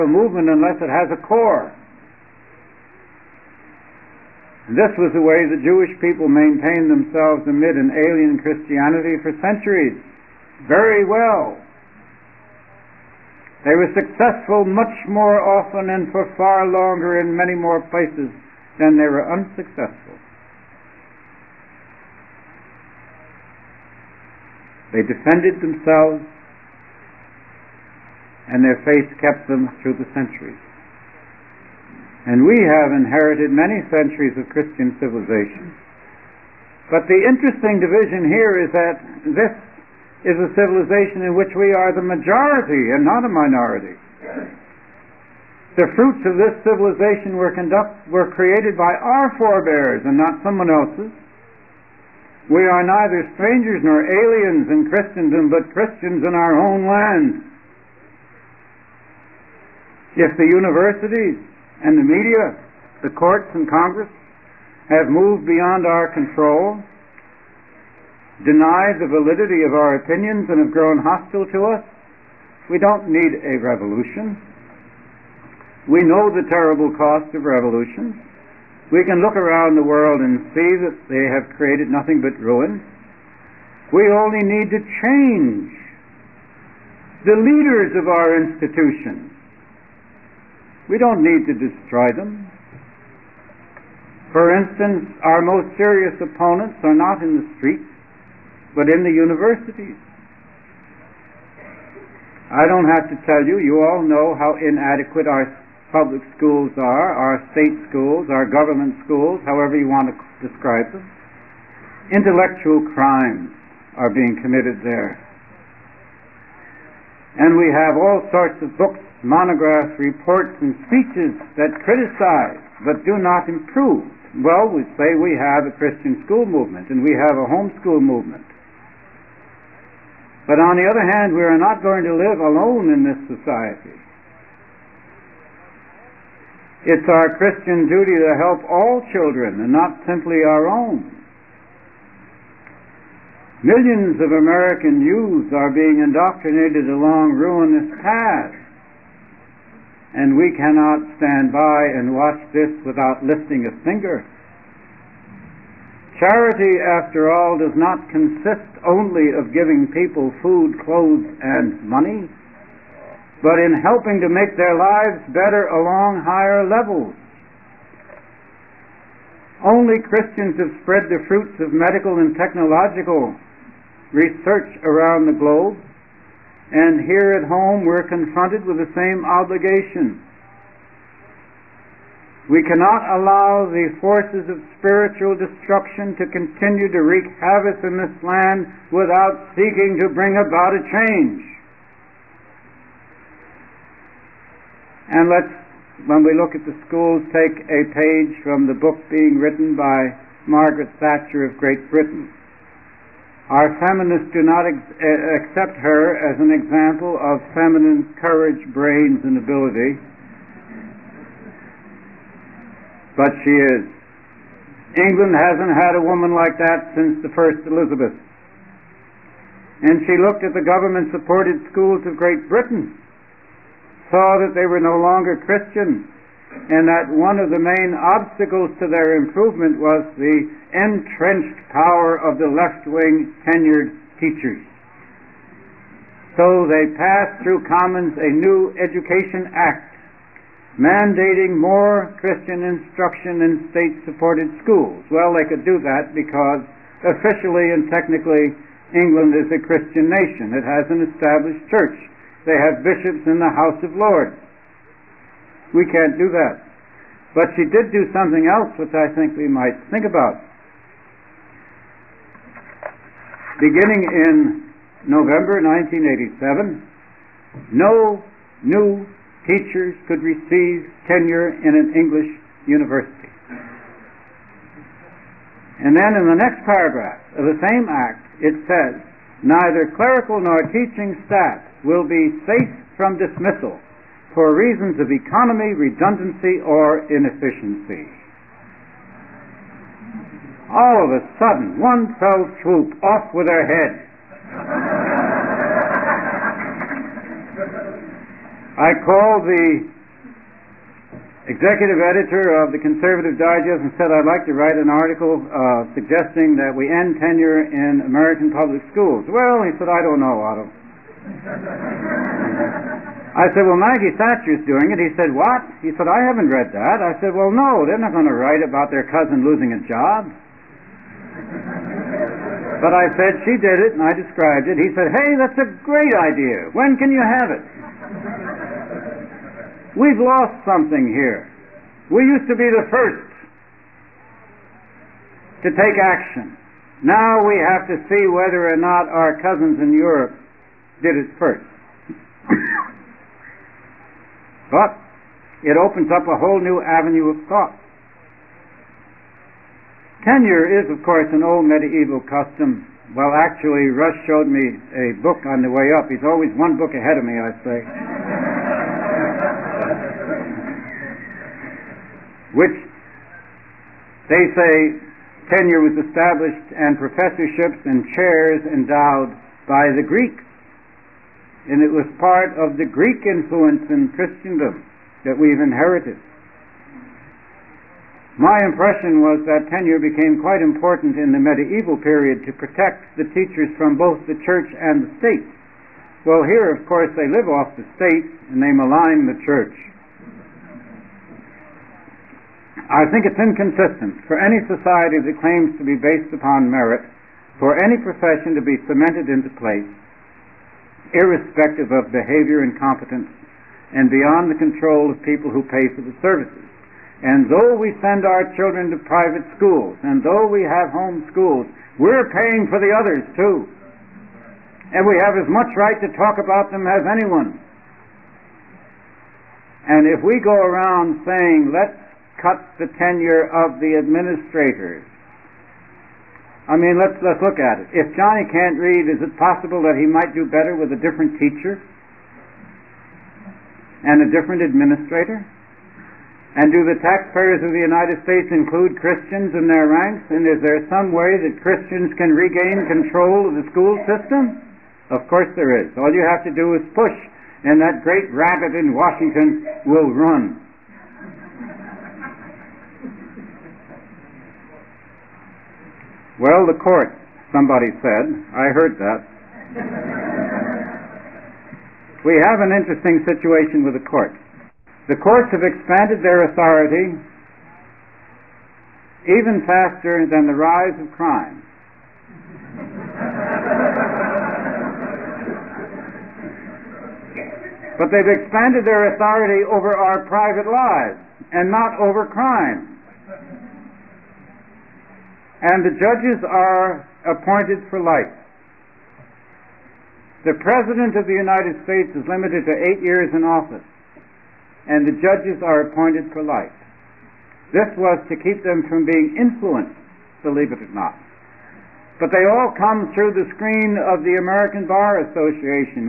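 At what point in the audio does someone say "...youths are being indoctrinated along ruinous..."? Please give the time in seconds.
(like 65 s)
145 s.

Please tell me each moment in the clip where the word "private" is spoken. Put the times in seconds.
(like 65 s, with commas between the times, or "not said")
409 s, 480 s.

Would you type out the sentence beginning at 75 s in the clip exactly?
We know the terrible cost of revolution.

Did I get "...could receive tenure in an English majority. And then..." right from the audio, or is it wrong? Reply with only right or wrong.
wrong.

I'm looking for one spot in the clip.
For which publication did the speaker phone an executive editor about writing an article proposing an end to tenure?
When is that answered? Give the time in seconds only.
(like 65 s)
302 s.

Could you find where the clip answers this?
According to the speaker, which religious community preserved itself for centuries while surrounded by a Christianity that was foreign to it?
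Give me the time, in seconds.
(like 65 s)
5 s.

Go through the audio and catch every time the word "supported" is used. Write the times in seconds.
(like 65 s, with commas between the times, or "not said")
221 s, 244 s.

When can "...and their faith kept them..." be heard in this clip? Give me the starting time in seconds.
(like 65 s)
28 s.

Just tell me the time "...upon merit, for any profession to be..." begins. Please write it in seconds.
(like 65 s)
396 s.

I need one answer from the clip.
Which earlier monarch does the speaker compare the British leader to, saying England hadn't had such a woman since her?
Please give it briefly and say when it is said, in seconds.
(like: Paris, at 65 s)
The first Elizabeth, at 217 s.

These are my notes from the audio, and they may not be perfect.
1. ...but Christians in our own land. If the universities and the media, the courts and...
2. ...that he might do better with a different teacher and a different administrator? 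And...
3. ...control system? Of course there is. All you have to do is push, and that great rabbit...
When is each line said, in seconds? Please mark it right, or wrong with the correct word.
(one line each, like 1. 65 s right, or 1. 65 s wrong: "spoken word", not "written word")
1. 55 s right
2. 429 s right
3. 443 s wrong: "school", not "control".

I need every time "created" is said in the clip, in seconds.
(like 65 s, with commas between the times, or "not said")
48 s, 81 s.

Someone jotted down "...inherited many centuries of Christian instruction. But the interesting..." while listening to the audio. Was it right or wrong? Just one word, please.
wrong.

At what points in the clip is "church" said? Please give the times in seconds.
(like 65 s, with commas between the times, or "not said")
251 s, 384 s, 389 s.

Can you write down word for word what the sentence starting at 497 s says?
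This was to keep them from being influenced, believe it or not.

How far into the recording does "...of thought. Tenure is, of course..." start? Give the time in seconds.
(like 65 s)
347 s.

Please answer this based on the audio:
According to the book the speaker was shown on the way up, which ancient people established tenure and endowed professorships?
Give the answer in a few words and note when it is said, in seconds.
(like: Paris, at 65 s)
The Greeks, at 369 s.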